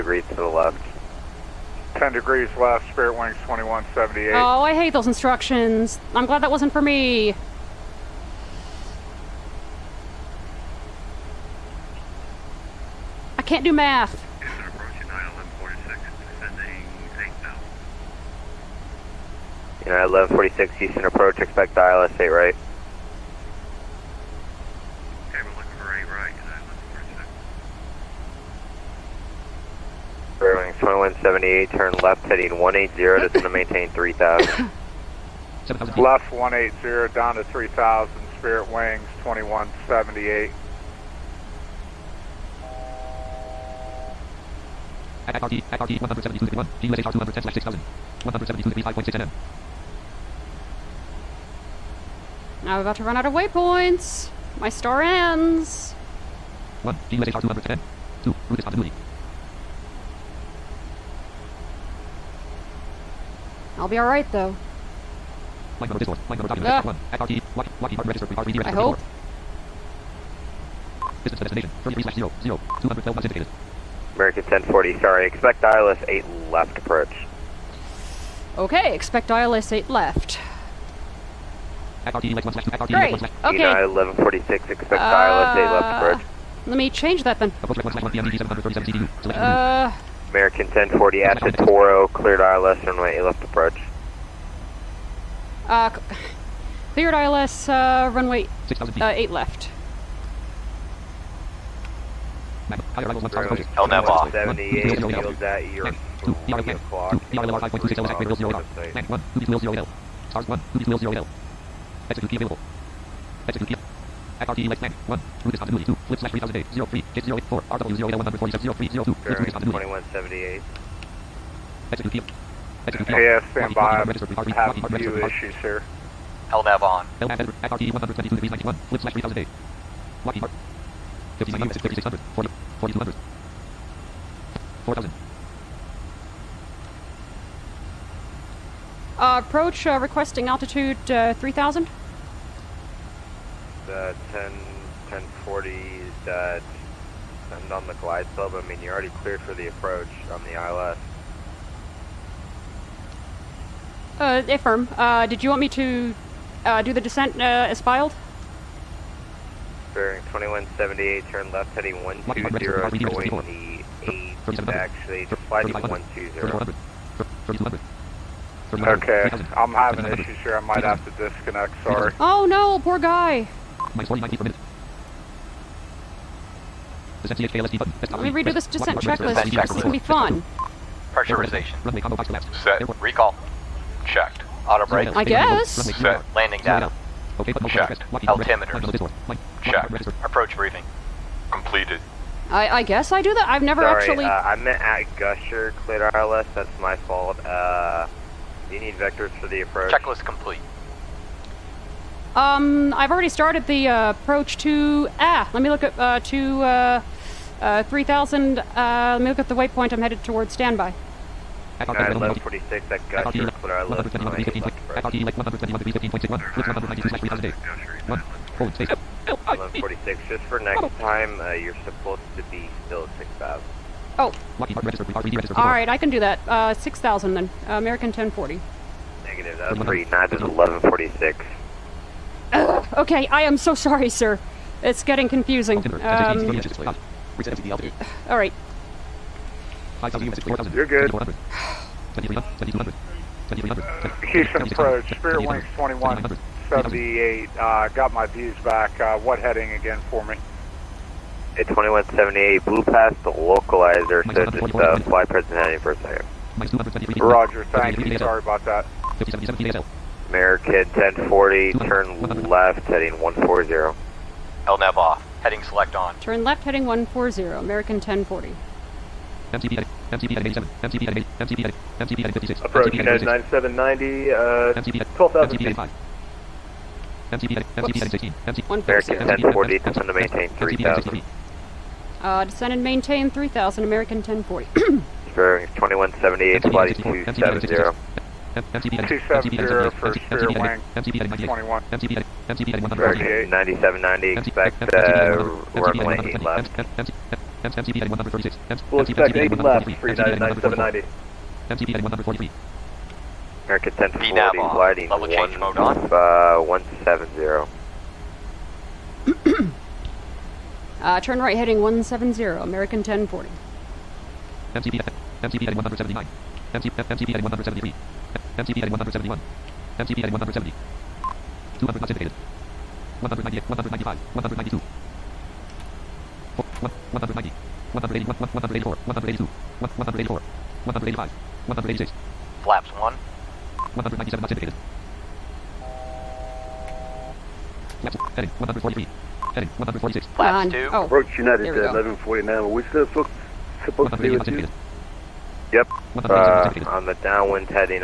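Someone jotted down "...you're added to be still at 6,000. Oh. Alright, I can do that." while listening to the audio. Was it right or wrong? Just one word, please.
wrong.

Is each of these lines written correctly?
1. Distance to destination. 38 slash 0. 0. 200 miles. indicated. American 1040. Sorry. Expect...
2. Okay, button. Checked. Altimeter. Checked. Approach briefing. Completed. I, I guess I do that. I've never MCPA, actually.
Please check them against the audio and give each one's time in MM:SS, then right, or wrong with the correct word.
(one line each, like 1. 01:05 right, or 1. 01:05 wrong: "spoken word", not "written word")
1. 01:11 wrong: "33", not "38"
2. 03:07 wrong: "Sorry", not "MCPA".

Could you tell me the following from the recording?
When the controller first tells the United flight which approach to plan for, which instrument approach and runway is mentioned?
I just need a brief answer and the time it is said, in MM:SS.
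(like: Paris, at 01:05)
ILS 8 right, at 00:21.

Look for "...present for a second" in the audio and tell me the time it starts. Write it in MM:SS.
04:15.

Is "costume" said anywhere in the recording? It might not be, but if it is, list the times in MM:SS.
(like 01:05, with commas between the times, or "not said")
not said.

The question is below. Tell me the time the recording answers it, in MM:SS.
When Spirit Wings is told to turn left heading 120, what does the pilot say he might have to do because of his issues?
02:51.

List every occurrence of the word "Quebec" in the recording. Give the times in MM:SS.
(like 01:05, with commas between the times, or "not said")
not said.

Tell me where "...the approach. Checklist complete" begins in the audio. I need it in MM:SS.
03:19.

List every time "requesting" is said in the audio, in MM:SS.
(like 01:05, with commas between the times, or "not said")
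02:19.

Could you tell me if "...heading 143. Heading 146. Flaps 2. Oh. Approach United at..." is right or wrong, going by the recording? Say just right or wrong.
right.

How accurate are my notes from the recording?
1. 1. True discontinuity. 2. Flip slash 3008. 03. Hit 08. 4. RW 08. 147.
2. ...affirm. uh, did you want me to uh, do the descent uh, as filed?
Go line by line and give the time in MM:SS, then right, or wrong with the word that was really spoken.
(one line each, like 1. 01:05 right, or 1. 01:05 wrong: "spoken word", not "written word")
1. 01:55 right
2. 02:34 right.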